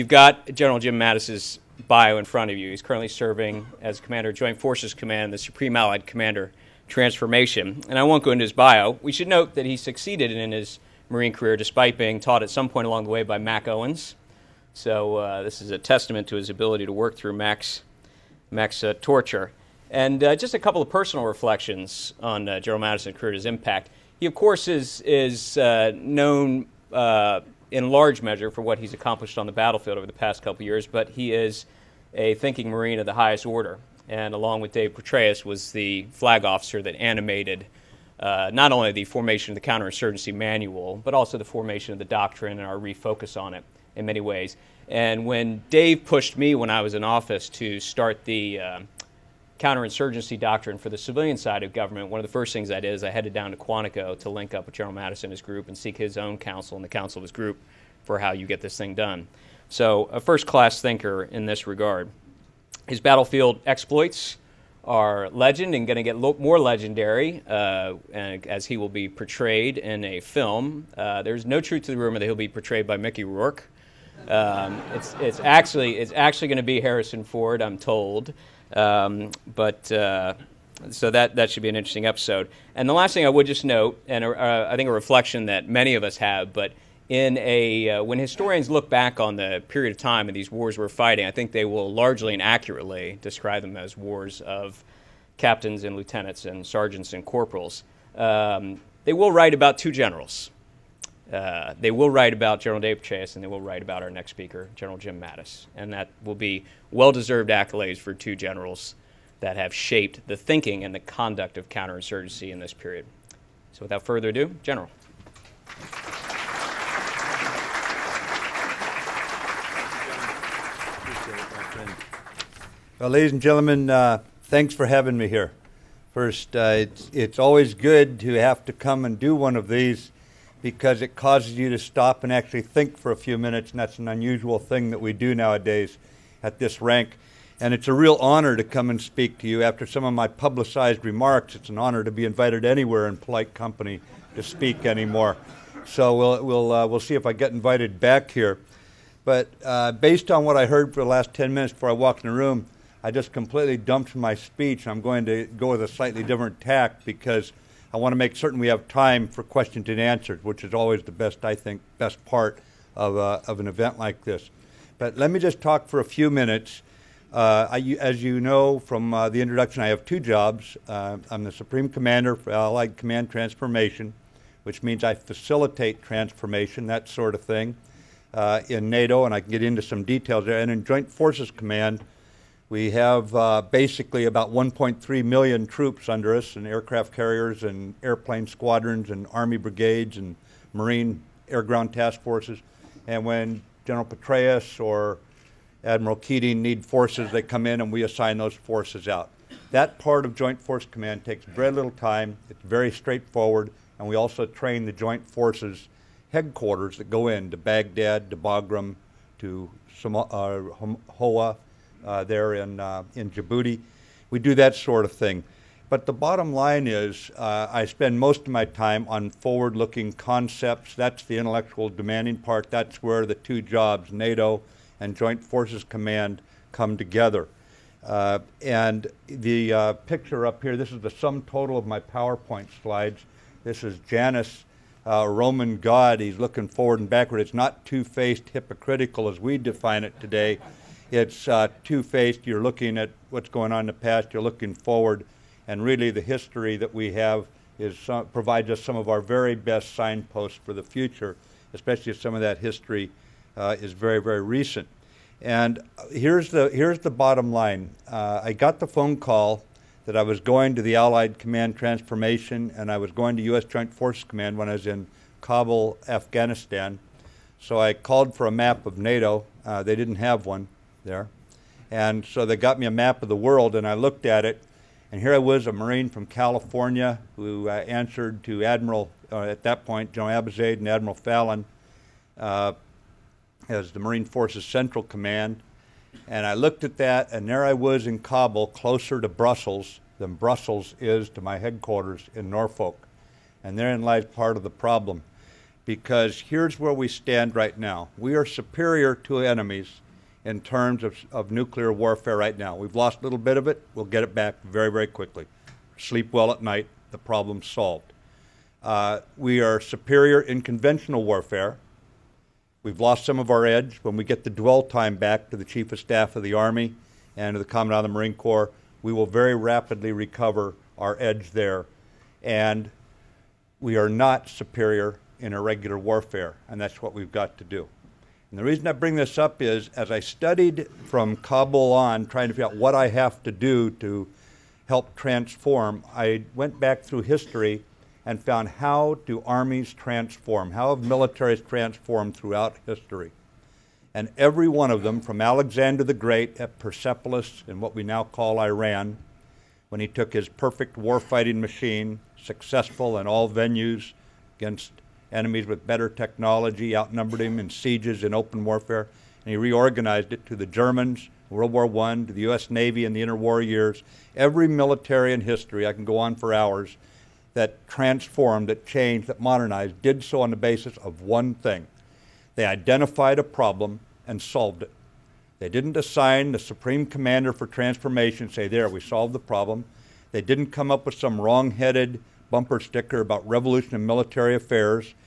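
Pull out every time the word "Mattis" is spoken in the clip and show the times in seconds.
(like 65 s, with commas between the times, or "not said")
0 s, 22 s, 54 s, 105 s.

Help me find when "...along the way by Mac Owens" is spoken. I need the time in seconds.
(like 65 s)
12 s.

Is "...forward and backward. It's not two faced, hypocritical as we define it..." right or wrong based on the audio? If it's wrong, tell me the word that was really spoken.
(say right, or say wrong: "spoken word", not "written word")
right.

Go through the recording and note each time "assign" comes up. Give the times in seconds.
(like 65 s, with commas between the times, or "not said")
198 s, 375 s.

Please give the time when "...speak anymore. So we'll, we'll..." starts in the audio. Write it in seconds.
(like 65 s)
144 s.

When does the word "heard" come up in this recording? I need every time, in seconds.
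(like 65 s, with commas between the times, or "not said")
150 s.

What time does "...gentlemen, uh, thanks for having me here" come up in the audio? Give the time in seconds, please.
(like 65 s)
123 s.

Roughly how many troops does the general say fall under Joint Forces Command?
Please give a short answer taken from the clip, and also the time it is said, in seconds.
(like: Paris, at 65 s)
1.3 million, at 184 s.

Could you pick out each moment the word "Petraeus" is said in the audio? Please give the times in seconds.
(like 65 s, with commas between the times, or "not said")
34 s, 103 s, 194 s.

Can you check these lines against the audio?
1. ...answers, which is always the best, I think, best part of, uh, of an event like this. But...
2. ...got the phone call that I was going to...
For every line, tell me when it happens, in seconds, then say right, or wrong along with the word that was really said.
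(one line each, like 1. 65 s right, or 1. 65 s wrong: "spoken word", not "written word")
1. 159 s right
2. 258 s right.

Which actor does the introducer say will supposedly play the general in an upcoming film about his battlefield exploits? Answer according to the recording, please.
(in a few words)
Harrison Ford.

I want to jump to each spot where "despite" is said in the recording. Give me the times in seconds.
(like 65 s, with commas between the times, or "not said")
11 s.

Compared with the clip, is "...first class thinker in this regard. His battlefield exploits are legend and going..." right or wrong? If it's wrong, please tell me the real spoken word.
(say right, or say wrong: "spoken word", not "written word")
right.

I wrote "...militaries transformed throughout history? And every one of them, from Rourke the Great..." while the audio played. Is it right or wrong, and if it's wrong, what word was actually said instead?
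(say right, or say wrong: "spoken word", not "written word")
wrong: "Alexander", not "Rourke".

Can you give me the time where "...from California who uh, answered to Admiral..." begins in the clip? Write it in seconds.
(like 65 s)
276 s.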